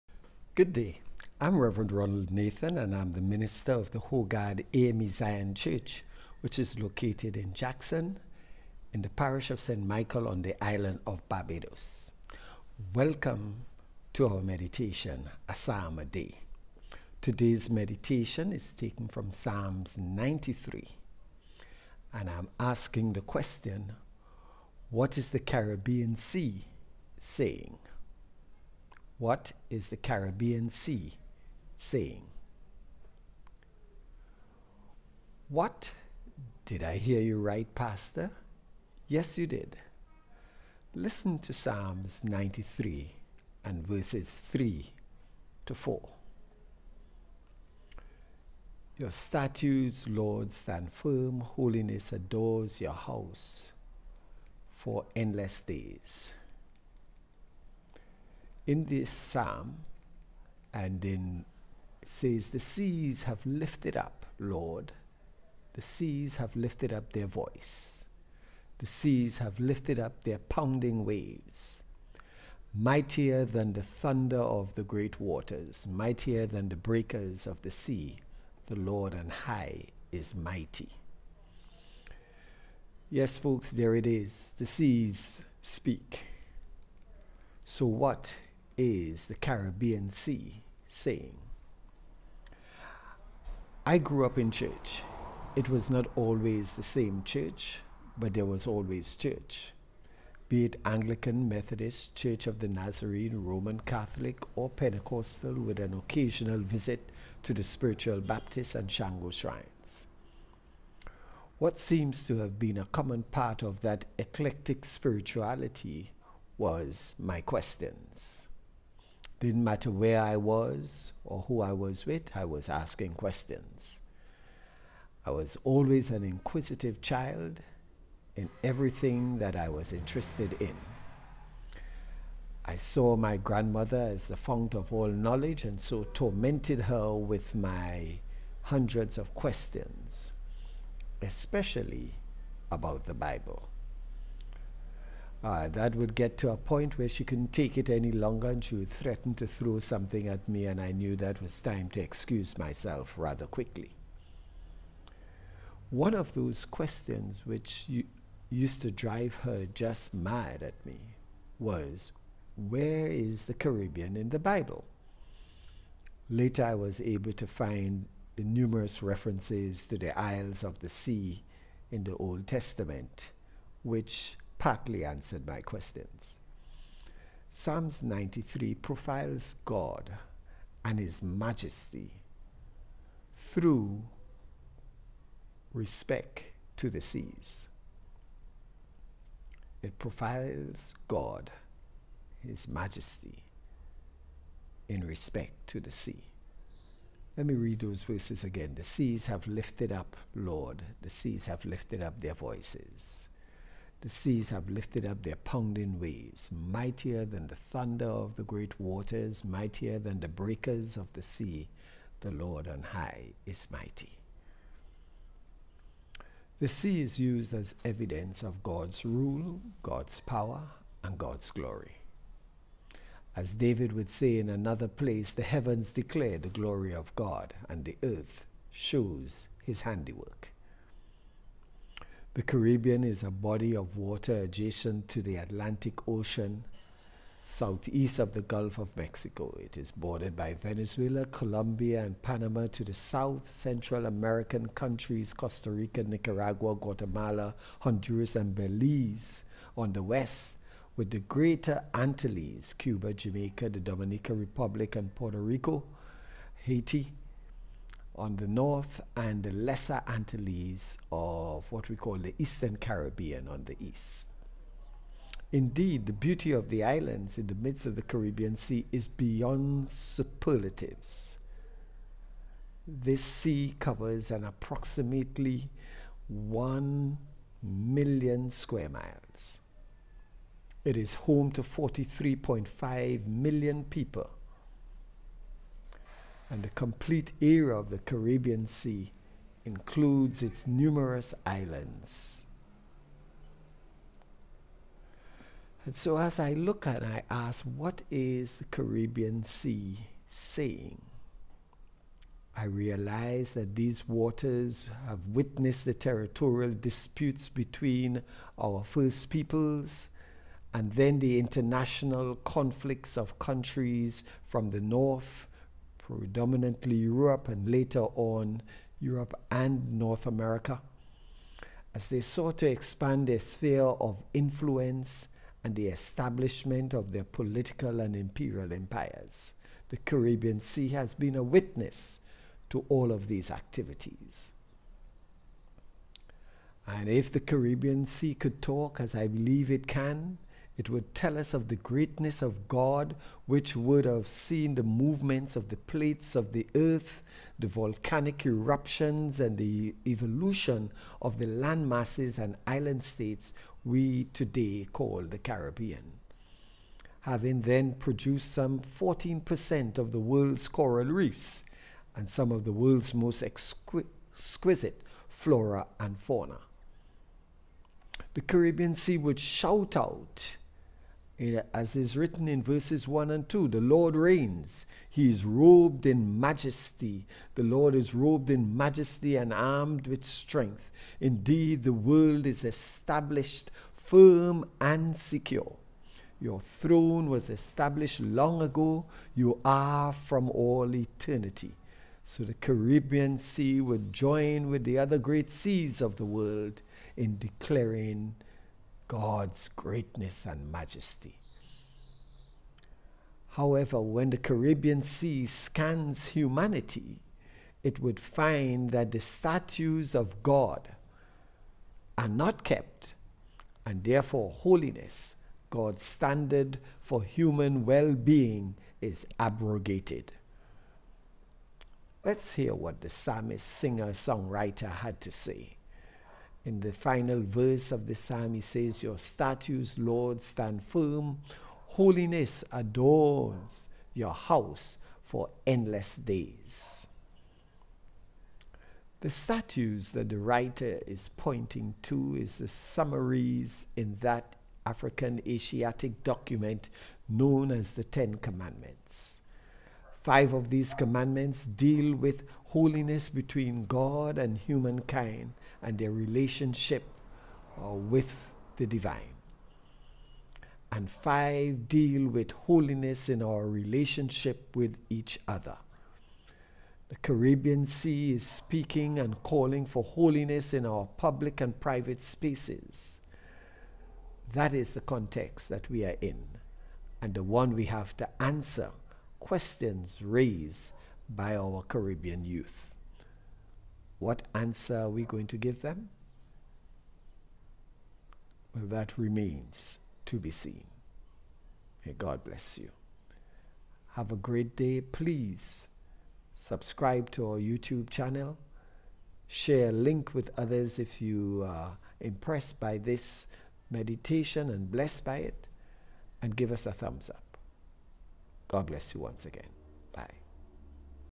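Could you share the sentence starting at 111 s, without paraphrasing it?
What seems to have been a common part of that eclectic spirituality was my questions.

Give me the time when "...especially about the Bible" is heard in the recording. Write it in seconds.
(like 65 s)
141 s.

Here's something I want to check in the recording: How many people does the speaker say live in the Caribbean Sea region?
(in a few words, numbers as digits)
43.5 million.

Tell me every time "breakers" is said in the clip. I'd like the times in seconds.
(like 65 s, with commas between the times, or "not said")
76 s, 210 s.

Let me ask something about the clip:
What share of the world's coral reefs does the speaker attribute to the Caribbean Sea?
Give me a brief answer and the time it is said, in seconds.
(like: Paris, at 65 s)
14%, at 358 s.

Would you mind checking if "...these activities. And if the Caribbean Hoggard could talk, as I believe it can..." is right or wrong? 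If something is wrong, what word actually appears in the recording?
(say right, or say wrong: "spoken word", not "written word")
wrong: "Sea", not "Hoggard".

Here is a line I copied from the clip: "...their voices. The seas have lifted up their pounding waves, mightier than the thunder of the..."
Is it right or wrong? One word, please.
right.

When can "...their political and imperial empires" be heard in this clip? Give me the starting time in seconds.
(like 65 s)
327 s.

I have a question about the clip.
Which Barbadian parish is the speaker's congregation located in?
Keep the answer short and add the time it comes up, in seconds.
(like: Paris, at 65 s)
St. Michael, at 9 s.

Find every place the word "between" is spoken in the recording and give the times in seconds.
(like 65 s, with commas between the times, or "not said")
307 s, 453 s.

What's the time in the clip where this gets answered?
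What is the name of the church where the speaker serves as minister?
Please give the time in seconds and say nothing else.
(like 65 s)
4 s.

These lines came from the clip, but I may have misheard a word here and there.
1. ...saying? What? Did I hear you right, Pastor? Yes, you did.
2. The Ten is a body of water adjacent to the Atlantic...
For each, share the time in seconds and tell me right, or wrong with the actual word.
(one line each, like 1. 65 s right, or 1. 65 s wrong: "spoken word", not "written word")
1. 31 s right
2. 232 s wrong: "Caribbean", not "Ten".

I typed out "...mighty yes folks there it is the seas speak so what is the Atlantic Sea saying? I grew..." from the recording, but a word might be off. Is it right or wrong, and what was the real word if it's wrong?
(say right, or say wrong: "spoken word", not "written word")
wrong: "Caribbean", not "Atlantic".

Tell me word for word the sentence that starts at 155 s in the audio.
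One of those questions which used to drive her just mad at me was where is the Caribbean in the Bible?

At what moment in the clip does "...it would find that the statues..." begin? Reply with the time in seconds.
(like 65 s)
407 s.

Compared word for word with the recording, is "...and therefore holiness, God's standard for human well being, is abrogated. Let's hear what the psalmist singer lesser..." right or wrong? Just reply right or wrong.
wrong.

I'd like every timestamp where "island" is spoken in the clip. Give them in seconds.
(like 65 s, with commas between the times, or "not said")
10 s, 266 s, 291 s, 352 s.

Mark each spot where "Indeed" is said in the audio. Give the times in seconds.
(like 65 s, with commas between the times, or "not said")
265 s, 381 s.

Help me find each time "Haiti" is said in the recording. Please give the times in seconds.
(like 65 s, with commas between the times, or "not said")
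256 s.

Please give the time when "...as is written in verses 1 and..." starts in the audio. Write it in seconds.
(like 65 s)
371 s.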